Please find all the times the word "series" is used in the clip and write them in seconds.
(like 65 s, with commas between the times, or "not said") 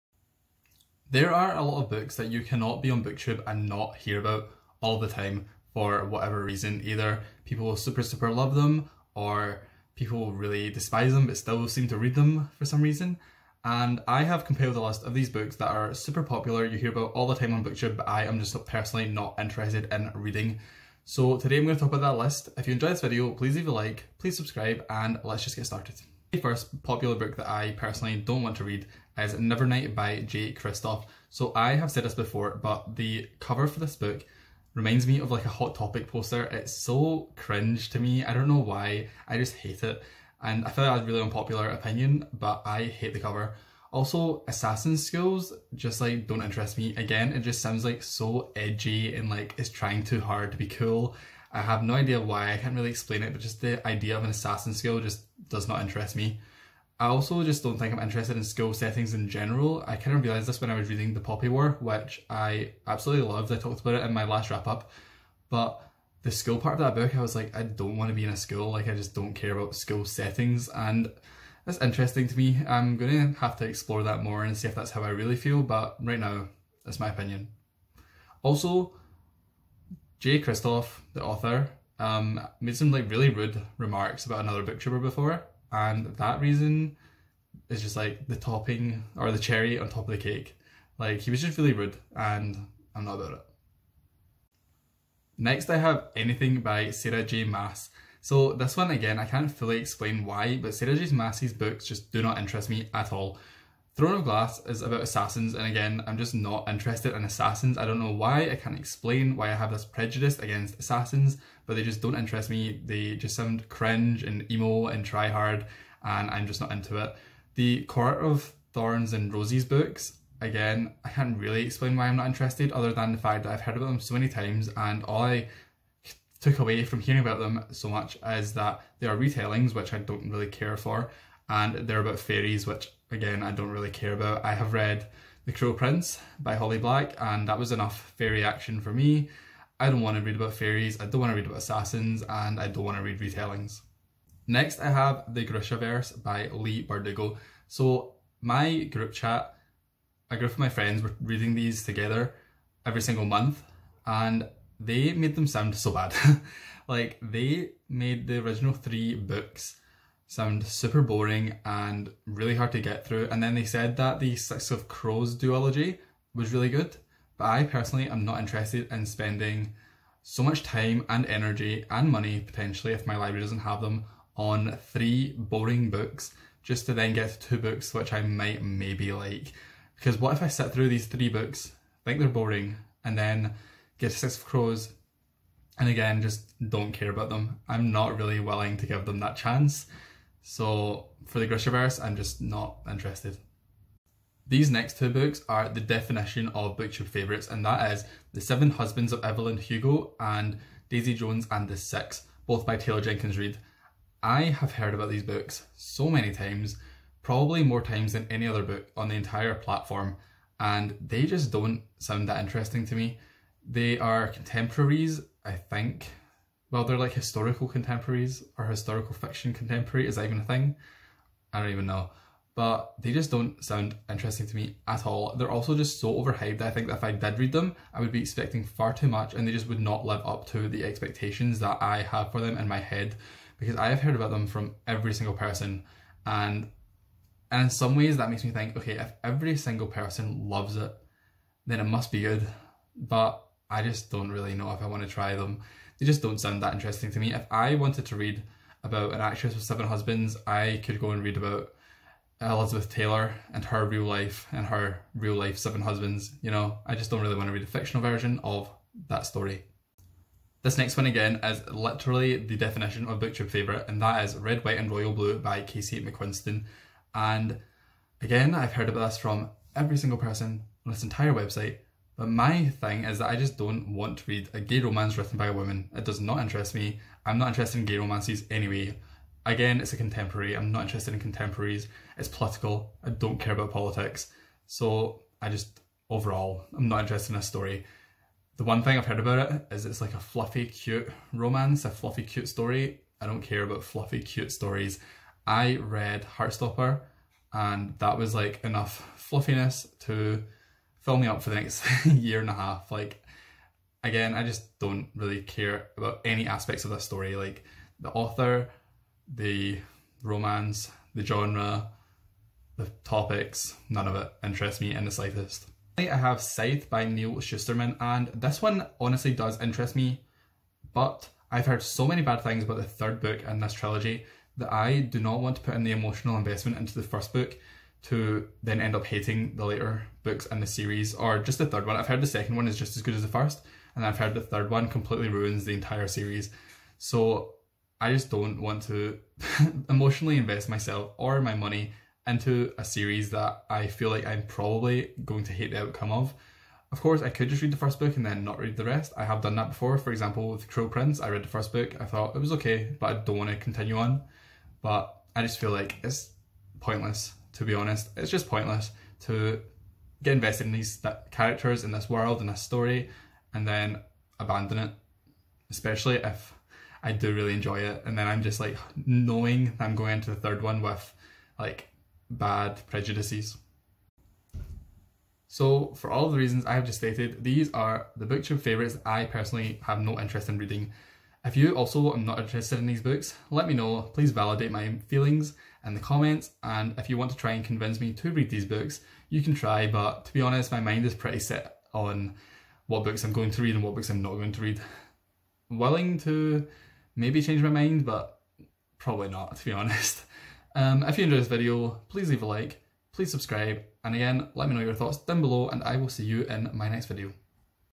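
330 s, 336 s, 342 s.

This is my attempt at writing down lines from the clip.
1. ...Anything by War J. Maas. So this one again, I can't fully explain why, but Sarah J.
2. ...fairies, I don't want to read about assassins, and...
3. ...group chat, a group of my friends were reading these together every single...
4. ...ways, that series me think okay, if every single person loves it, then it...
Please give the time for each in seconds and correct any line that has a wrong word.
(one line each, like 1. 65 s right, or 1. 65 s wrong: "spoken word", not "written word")
1. 96 s wrong: "Sarah", not "War"
2. 140 s right
3. 148 s right
4. 237 s wrong: "makes", not "series".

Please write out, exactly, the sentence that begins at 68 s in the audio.
Like, I just don't care about school settings.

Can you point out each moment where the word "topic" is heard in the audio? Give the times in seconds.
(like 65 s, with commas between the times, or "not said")
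35 s, 313 s.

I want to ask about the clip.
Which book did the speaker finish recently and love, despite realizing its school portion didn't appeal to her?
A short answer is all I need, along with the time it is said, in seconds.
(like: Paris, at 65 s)
The Poppy War, at 61 s.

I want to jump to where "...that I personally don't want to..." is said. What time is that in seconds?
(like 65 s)
27 s.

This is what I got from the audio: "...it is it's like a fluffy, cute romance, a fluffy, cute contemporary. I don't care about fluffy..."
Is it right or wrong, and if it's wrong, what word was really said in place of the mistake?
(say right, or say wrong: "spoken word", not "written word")
wrong: "story", not "contemporary".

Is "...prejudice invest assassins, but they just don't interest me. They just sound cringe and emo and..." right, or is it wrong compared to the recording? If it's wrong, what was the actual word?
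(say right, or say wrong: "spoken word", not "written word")
wrong: "against", not "invest".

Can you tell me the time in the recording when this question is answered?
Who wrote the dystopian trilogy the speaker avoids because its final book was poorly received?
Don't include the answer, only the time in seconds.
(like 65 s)
317 s.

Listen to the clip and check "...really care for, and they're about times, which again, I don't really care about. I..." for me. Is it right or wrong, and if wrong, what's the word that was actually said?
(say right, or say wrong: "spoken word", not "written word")
wrong: "fairies", not "times".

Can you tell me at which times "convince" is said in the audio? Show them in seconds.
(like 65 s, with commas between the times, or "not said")
387 s.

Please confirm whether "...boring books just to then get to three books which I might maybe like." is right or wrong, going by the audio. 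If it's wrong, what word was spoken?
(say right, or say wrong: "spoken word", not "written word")
wrong: "two", not "three".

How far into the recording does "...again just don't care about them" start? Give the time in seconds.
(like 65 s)
185 s.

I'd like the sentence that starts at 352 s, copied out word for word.
I thought it was okay, but I don't want to continue on.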